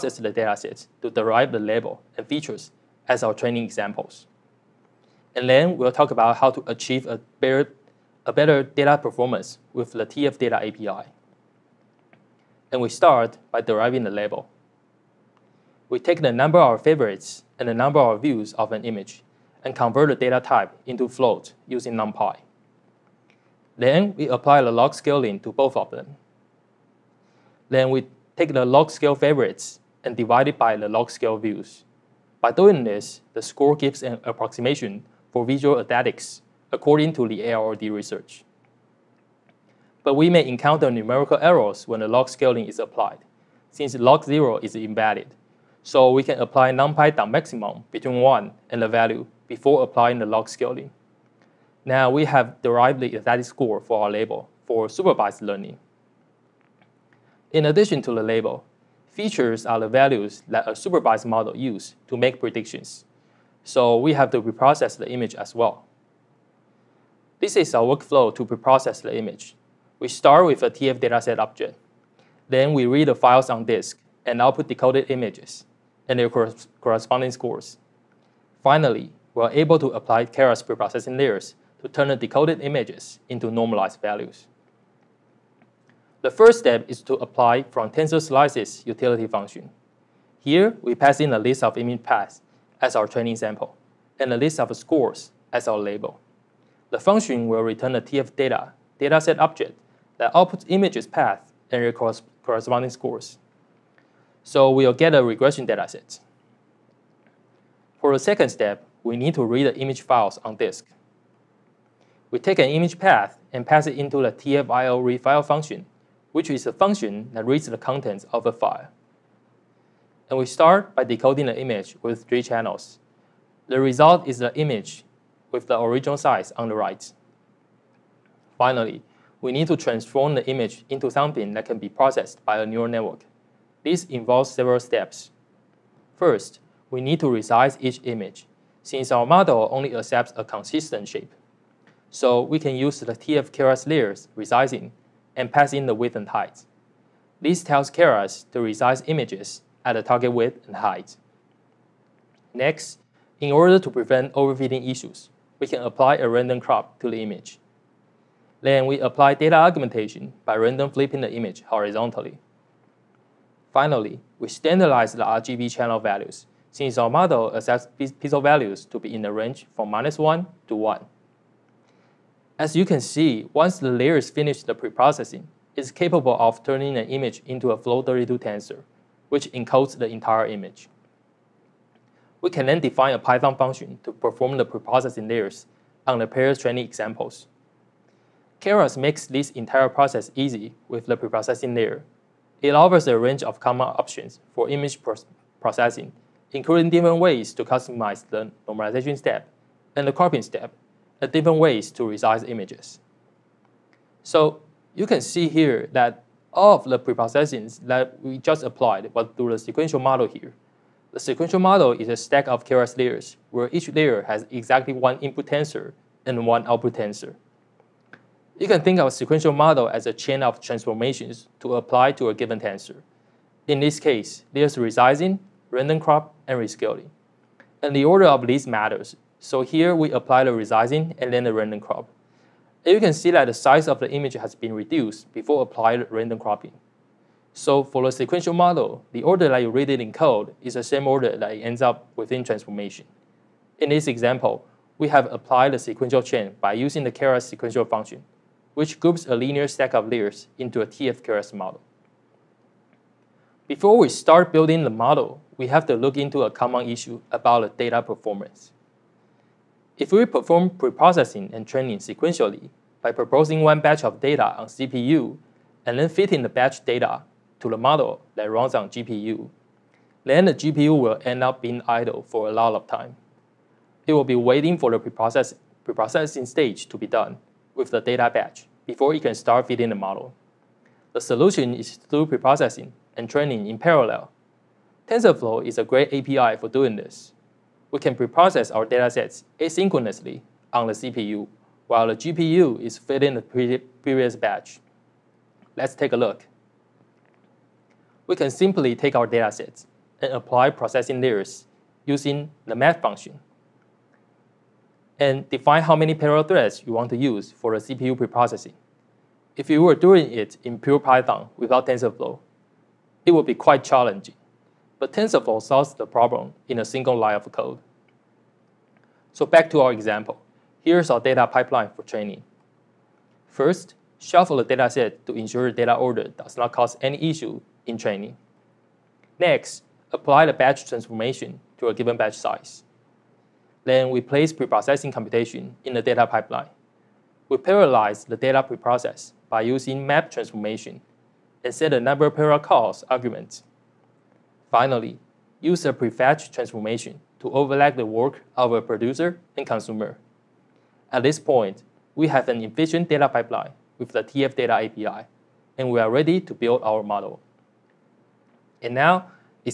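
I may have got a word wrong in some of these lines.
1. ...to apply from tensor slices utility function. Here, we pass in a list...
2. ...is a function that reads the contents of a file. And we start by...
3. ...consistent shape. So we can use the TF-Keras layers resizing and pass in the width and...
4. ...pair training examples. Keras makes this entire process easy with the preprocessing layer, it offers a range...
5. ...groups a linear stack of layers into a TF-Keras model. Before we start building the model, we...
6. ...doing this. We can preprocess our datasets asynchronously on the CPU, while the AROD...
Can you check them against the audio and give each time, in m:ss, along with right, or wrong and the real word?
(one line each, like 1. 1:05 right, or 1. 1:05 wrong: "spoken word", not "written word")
1. 1:27 right
2. 1:56 right
3. 2:20 right
4. 3:06 right
5. 4:08 right
6. 4:46 wrong: "GPU", not "AROD".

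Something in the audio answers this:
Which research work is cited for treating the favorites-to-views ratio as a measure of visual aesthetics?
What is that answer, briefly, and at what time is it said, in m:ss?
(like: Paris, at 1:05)
AROD, at 0:37.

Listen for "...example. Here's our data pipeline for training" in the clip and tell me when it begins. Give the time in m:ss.
5:19.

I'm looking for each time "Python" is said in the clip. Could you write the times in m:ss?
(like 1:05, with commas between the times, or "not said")
3:03, 5:10.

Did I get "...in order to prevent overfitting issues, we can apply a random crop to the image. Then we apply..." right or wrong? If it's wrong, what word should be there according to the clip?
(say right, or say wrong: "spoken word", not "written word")
right.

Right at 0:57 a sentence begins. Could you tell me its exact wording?
In addition to the label, features are the values that a supervised model uses to make predictions.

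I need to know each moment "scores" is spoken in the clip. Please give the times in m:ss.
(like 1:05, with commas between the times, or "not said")
0:33, 0:53, 1:17, 1:34, 1:42.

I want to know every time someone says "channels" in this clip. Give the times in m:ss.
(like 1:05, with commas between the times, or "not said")
2:02, 2:45.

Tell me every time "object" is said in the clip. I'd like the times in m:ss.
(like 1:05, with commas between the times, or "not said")
1:11, 1:39.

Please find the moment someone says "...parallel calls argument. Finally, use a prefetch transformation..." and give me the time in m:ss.
5:42.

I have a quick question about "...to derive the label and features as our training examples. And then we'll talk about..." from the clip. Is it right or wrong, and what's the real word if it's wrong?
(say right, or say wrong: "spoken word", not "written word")
right.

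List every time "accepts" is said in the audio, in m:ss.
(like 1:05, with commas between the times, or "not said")
2:19, 2:47.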